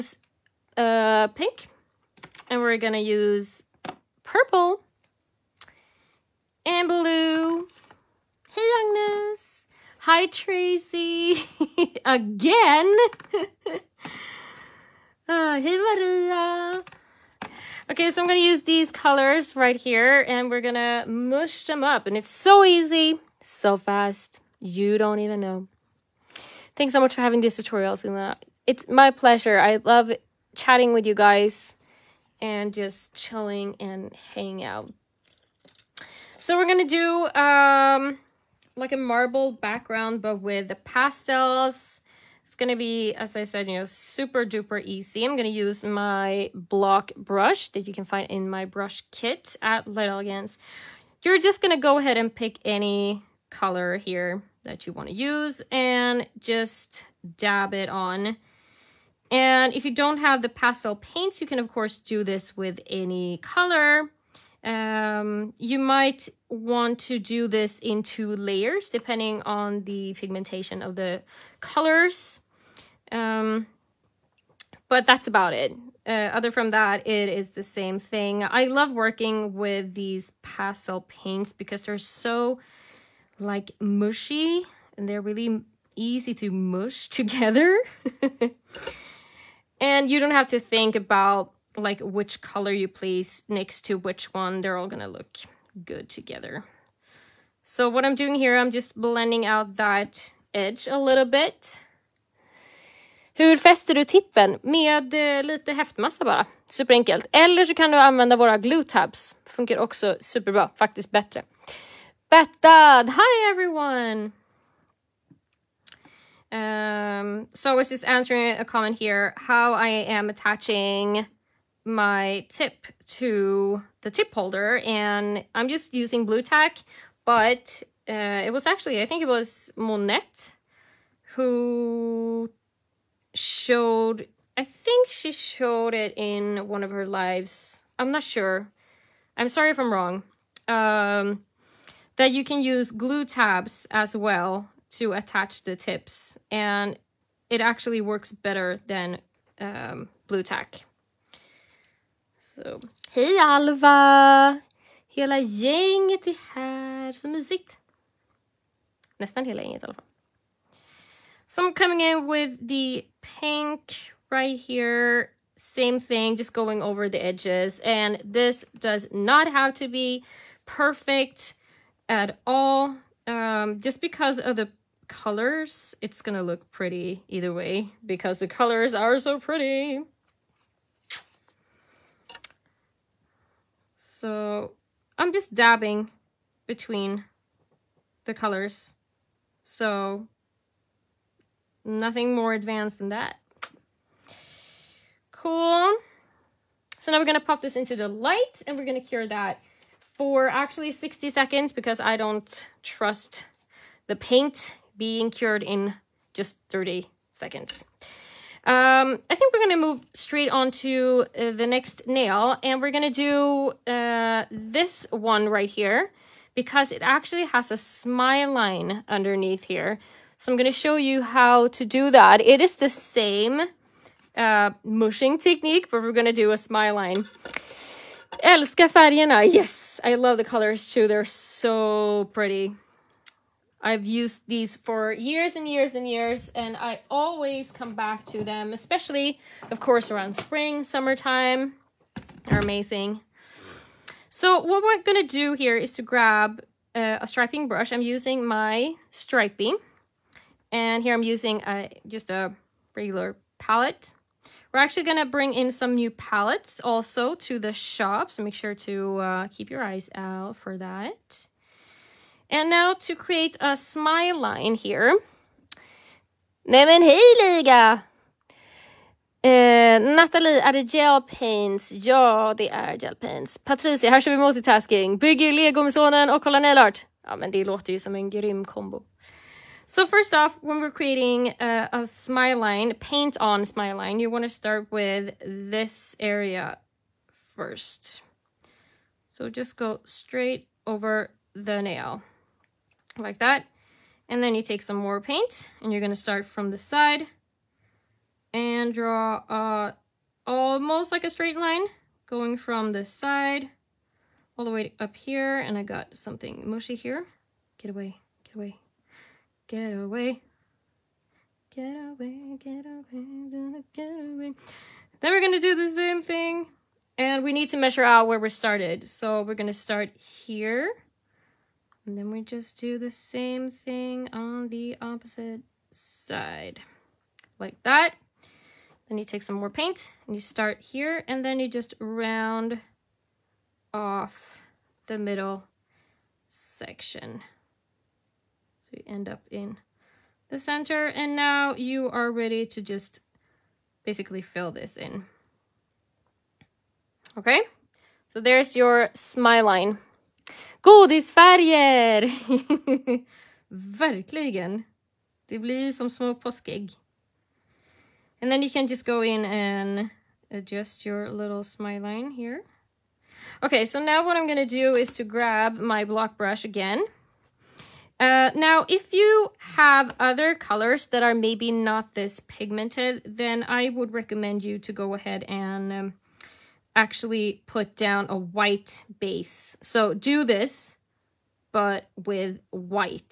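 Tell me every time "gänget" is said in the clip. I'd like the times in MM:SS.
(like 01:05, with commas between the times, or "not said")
02:35, 02:39.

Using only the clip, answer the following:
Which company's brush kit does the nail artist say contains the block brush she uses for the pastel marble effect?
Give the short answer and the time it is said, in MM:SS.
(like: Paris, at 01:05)
Light Elegance, at 00:49.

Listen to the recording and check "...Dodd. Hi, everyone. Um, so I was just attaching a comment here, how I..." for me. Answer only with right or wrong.
wrong.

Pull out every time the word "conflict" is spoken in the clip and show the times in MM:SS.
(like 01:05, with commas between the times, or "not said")
not said.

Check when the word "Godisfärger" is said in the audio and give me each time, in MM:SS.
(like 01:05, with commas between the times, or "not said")
05:50.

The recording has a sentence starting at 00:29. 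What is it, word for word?
I love chatting with you guys and just chilling and hanging out.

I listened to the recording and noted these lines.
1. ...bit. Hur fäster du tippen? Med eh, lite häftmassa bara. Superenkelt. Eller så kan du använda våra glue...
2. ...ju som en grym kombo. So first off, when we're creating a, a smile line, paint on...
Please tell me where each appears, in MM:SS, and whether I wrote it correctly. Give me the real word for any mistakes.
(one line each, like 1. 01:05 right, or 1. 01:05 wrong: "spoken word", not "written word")
1. 01:41 right
2. 04:37 right.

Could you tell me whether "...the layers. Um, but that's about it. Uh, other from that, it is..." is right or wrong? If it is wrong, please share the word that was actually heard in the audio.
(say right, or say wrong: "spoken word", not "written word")
wrong: "colors", not "layers".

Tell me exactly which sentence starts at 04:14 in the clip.
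We're actually going to bring in some new palettes also to the shop.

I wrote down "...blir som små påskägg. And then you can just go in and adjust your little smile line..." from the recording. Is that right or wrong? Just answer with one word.
right.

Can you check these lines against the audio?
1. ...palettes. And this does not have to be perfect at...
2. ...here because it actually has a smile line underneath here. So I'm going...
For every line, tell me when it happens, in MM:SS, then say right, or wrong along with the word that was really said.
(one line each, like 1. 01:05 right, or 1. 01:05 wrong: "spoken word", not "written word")
1. 02:47 wrong: "edges", not "palettes"
2. 03:35 right.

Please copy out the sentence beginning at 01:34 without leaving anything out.
They're all gonna look good together.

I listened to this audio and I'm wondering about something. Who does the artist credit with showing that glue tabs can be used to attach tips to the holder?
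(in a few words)
Monette.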